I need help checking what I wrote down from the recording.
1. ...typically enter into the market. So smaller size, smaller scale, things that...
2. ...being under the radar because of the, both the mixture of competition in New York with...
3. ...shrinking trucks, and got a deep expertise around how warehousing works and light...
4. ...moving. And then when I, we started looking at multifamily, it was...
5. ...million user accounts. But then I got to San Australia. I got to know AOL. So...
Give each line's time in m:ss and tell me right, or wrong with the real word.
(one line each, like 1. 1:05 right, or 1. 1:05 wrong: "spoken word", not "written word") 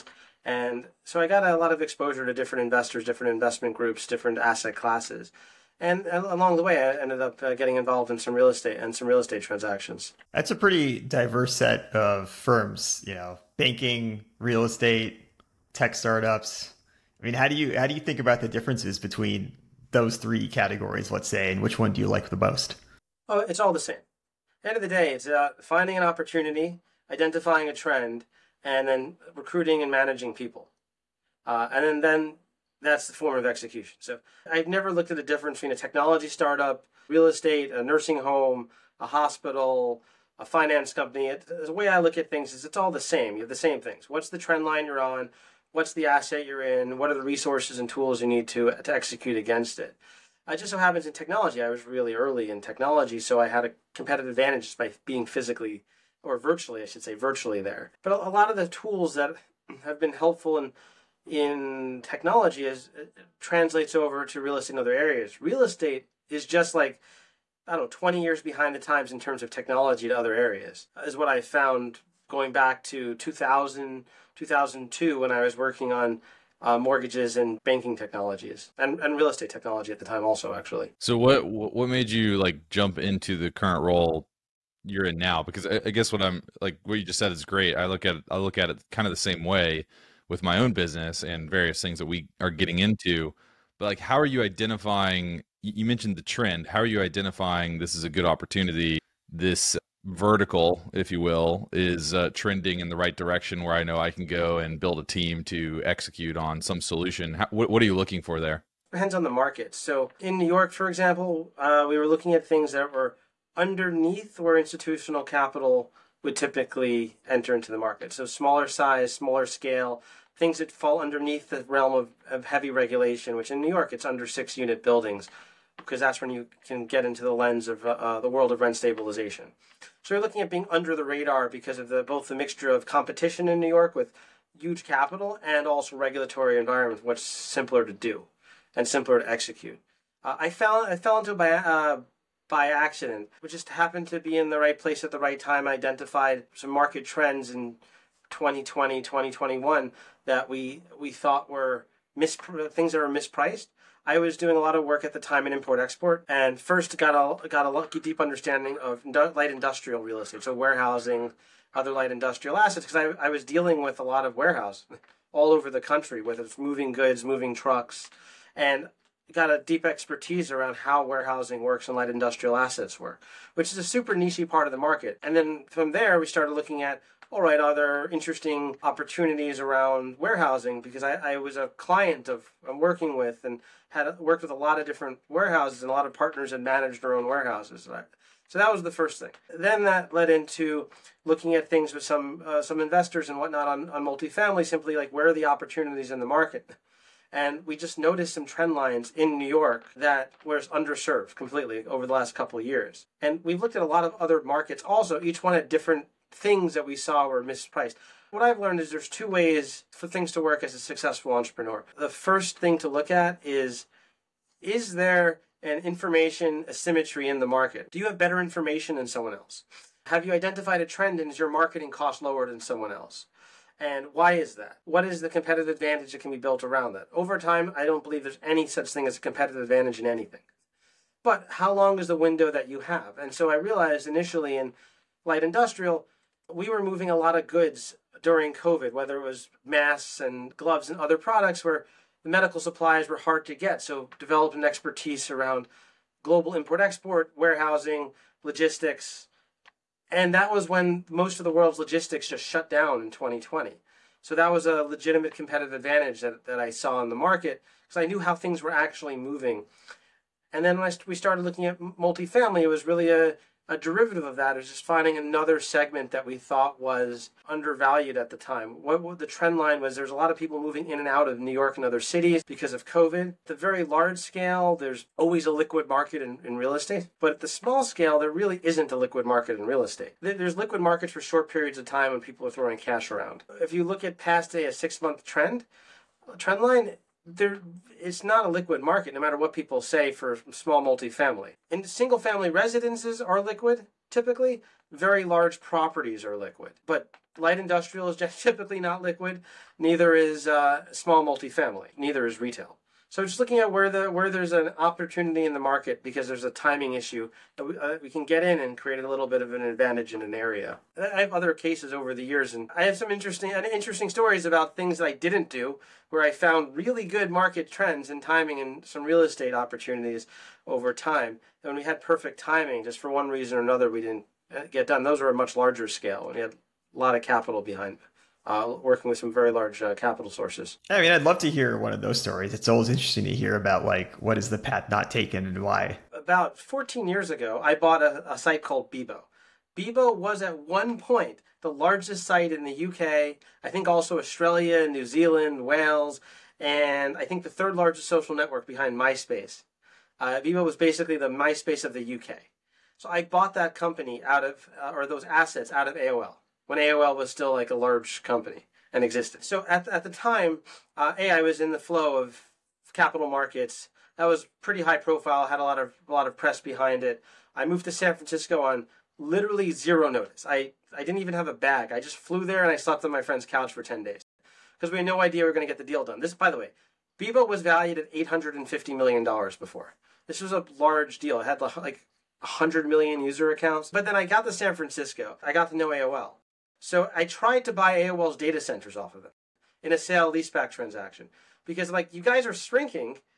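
1. 1:56 right
2. 2:10 right
3. 2:47 wrong: "moving", not "shrinking"
4. 4:19 right
5. 6:22 wrong: "Francisco", not "Australia".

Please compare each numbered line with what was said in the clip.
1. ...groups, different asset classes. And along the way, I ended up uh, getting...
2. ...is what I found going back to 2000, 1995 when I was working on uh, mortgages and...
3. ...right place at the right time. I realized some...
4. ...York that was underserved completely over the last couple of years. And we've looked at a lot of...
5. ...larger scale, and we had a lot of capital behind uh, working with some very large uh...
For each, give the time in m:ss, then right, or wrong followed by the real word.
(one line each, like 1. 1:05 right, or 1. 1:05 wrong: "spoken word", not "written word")
1. 0:03 right
2. 1:11 wrong: "2002", not "1995"
3. 2:24 wrong: "identified", not "realized"
4. 3:19 right
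5. 5:25 right.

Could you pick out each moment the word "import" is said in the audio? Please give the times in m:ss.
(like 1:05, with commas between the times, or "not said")
2:35, 4:06.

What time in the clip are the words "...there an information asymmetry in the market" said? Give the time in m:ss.
3:34.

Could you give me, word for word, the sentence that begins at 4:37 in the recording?
But at the small scale, there really isn't a liquid market in real estate.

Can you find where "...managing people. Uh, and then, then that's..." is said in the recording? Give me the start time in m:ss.
0:29.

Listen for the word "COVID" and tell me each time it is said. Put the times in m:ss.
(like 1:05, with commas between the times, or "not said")
3:58, 4:32.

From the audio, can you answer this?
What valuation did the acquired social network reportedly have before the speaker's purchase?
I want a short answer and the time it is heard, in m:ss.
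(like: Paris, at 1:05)
$850 million, at 6:18.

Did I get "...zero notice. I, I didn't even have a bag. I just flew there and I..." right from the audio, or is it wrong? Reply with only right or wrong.
right.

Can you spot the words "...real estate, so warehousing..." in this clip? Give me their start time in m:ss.
2:40.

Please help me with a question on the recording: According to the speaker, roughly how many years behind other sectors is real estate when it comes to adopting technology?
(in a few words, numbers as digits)
20 years.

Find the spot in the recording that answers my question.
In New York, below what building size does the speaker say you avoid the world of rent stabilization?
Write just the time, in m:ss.
2:04.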